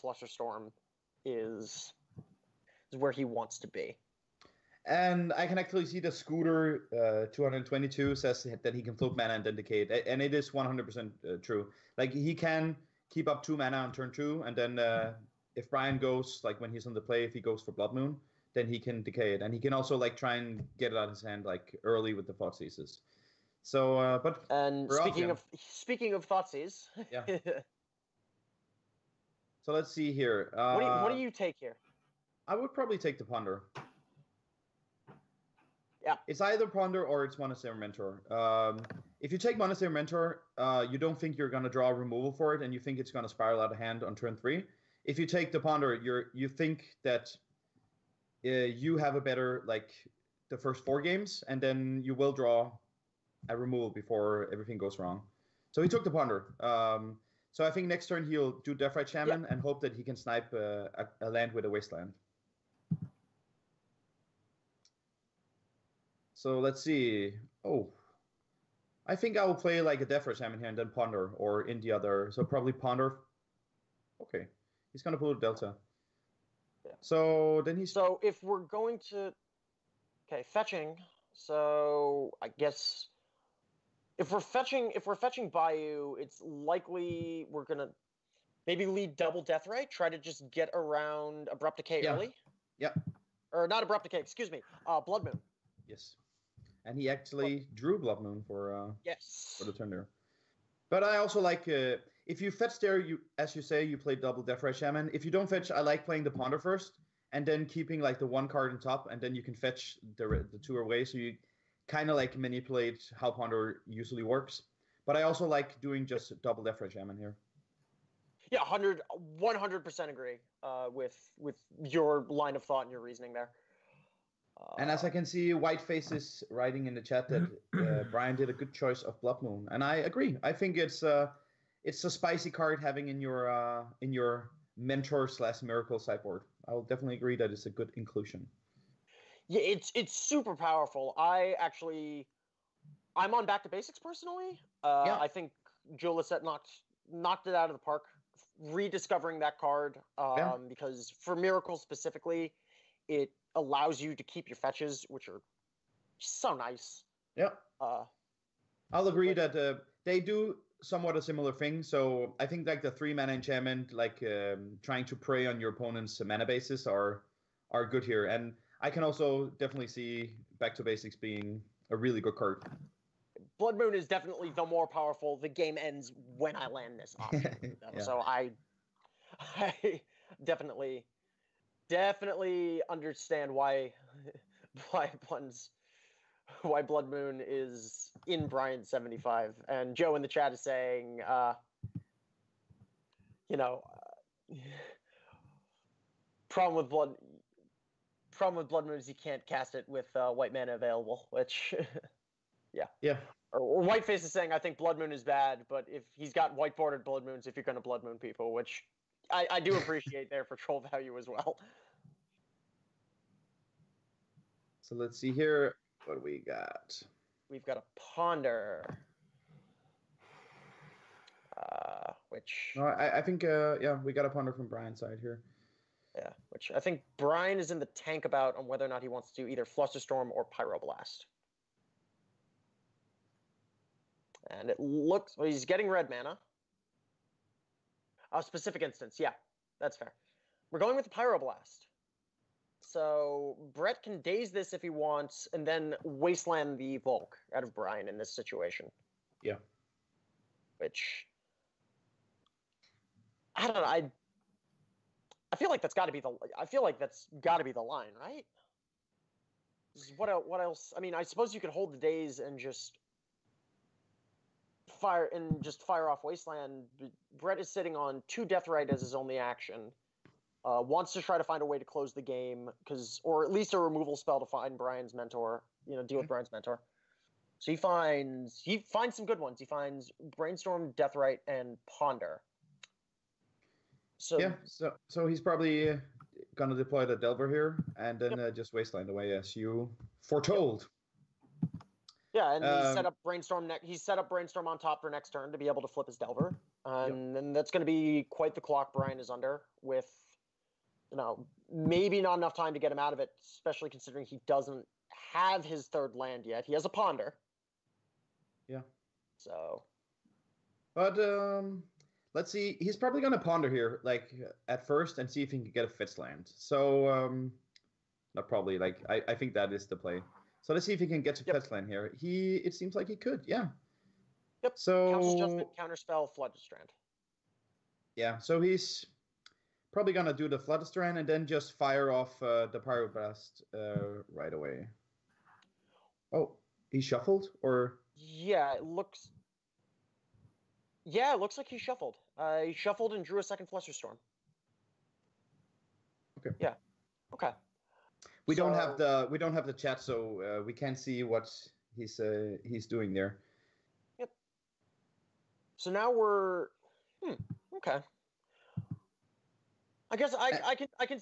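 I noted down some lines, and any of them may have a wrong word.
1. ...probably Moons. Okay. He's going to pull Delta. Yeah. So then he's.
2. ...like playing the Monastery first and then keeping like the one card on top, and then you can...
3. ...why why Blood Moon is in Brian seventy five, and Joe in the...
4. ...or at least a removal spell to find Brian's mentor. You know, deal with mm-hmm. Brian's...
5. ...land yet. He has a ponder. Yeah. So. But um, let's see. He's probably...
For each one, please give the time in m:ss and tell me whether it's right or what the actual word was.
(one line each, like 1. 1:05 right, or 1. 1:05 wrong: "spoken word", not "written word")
1. 1:12 wrong: "Ponder", not "Moons"
2. 1:45 wrong: "Ponder", not "Monastery"
3. 3:04 right
4. 4:33 right
5. 5:06 right.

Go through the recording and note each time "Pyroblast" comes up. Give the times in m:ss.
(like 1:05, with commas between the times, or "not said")
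3:50, 4:01, 5:32.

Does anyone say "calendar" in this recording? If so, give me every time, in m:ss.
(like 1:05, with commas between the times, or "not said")
not said.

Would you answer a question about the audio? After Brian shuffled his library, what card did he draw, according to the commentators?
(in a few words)
A second Flusterstorm.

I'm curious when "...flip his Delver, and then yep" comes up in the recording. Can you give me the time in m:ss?
4:55.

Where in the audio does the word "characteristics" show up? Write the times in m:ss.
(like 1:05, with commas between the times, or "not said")
not said.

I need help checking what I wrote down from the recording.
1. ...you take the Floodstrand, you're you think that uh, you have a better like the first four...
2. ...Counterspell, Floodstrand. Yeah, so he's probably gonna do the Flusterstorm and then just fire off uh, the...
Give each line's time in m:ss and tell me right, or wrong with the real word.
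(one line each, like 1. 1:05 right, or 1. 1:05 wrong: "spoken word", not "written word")
1. 0:45 wrong: "Ponder", not "Floodstrand"
2. 5:25 wrong: "Floodstrand", not "Flusterstorm".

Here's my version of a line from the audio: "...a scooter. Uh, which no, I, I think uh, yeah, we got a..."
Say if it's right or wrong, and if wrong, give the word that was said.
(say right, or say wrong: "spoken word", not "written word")
wrong: "ponder", not "scooter".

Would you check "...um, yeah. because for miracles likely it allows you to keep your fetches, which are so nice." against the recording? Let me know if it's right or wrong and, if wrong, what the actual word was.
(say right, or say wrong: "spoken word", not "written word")
wrong: "specifically", not "likely".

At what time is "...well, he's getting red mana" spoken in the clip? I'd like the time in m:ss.
3:55.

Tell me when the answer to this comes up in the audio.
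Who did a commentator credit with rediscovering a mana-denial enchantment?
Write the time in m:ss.
2:25.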